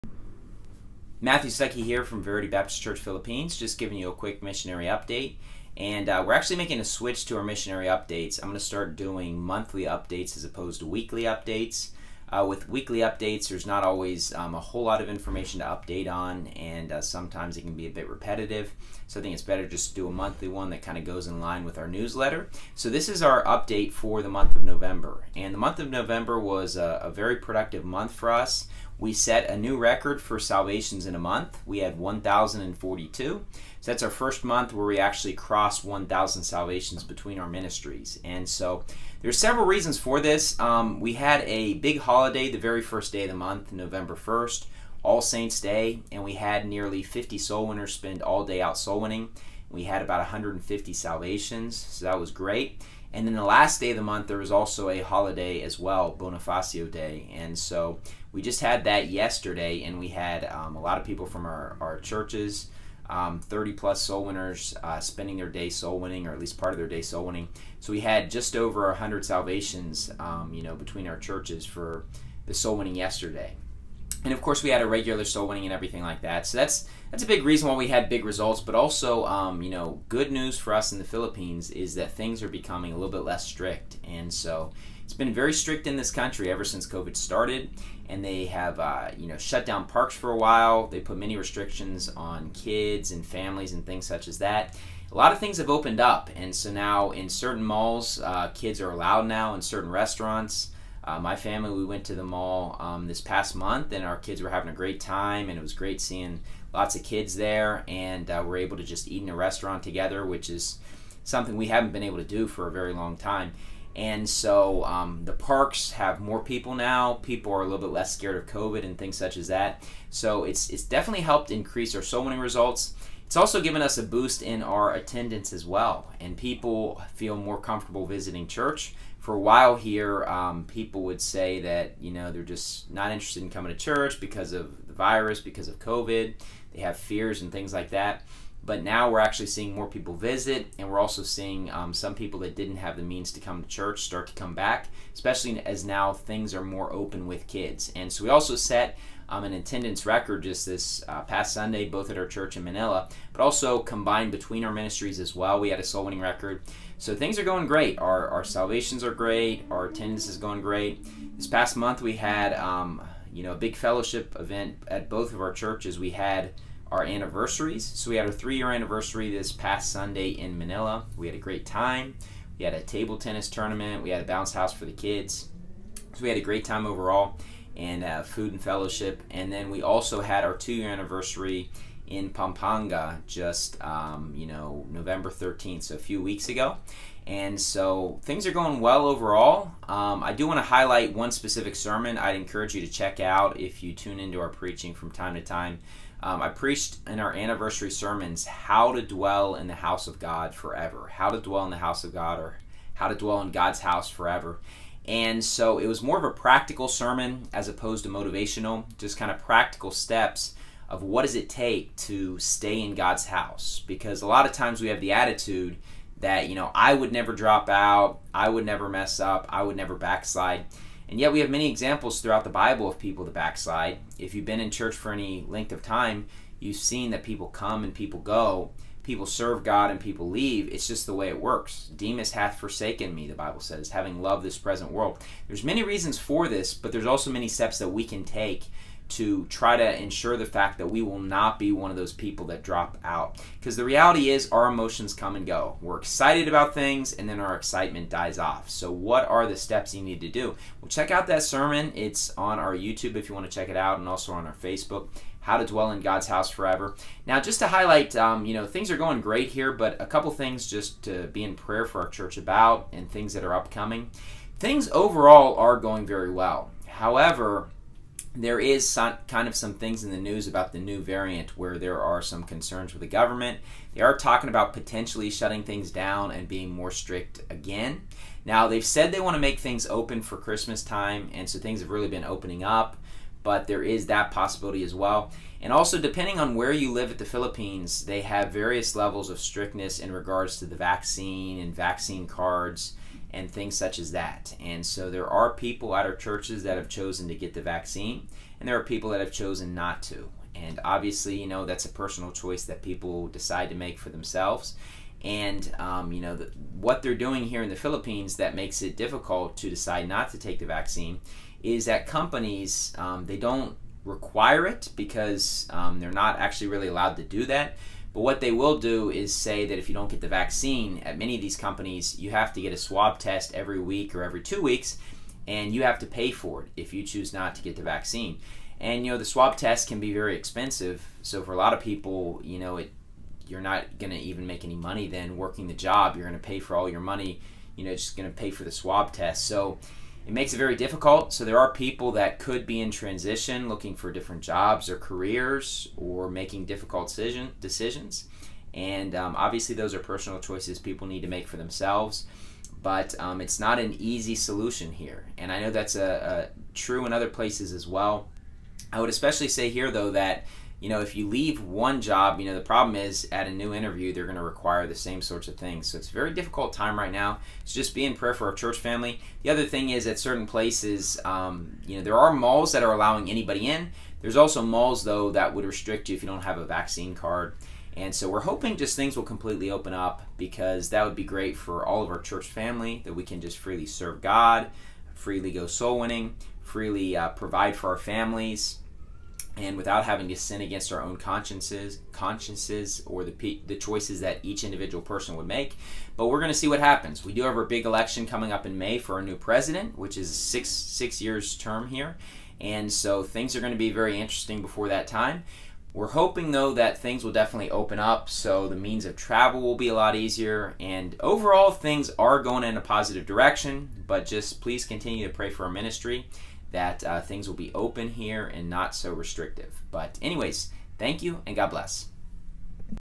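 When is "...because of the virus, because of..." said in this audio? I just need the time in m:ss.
2:14.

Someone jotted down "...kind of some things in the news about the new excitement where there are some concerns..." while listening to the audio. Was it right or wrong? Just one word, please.
wrong.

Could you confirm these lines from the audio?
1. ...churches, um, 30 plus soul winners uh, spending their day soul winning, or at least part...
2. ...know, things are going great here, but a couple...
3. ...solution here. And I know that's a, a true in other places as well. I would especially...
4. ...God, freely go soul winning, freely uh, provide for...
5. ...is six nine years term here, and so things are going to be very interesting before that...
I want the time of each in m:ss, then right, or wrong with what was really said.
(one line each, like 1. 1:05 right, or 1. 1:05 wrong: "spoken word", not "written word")
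1. 1:01 right
2. 4:18 right
3. 5:54 right
4. 6:24 right
5. 6:40 wrong: "six", not "nine".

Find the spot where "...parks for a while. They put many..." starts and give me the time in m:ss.
1:29.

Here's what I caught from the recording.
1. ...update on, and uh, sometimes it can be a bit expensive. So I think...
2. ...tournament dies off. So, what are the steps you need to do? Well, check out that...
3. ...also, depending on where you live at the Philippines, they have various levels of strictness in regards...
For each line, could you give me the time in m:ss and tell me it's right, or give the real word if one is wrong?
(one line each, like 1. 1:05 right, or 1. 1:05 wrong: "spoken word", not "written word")
1. 0:15 wrong: "repetitive", not "expensive"
2. 4:07 wrong: "excitement", not "tournament"
3. 4:45 right.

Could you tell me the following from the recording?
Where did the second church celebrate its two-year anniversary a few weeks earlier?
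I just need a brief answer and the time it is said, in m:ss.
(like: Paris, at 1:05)
Pampanga, at 3:02.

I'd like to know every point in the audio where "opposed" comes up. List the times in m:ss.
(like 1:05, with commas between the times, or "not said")
0:10, 3:27.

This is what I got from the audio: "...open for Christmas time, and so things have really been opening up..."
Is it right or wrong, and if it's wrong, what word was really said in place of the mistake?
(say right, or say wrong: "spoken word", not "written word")
right.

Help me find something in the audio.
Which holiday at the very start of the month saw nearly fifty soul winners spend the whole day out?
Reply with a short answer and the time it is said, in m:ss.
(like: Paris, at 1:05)
All Saints Day, at 0:45.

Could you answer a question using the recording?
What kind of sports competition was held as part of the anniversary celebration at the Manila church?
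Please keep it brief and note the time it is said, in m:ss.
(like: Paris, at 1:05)
table tennis tournament, at 2:52.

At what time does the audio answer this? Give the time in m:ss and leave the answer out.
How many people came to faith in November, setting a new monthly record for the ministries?
0:31.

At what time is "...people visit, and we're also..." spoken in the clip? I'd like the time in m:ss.
2:19.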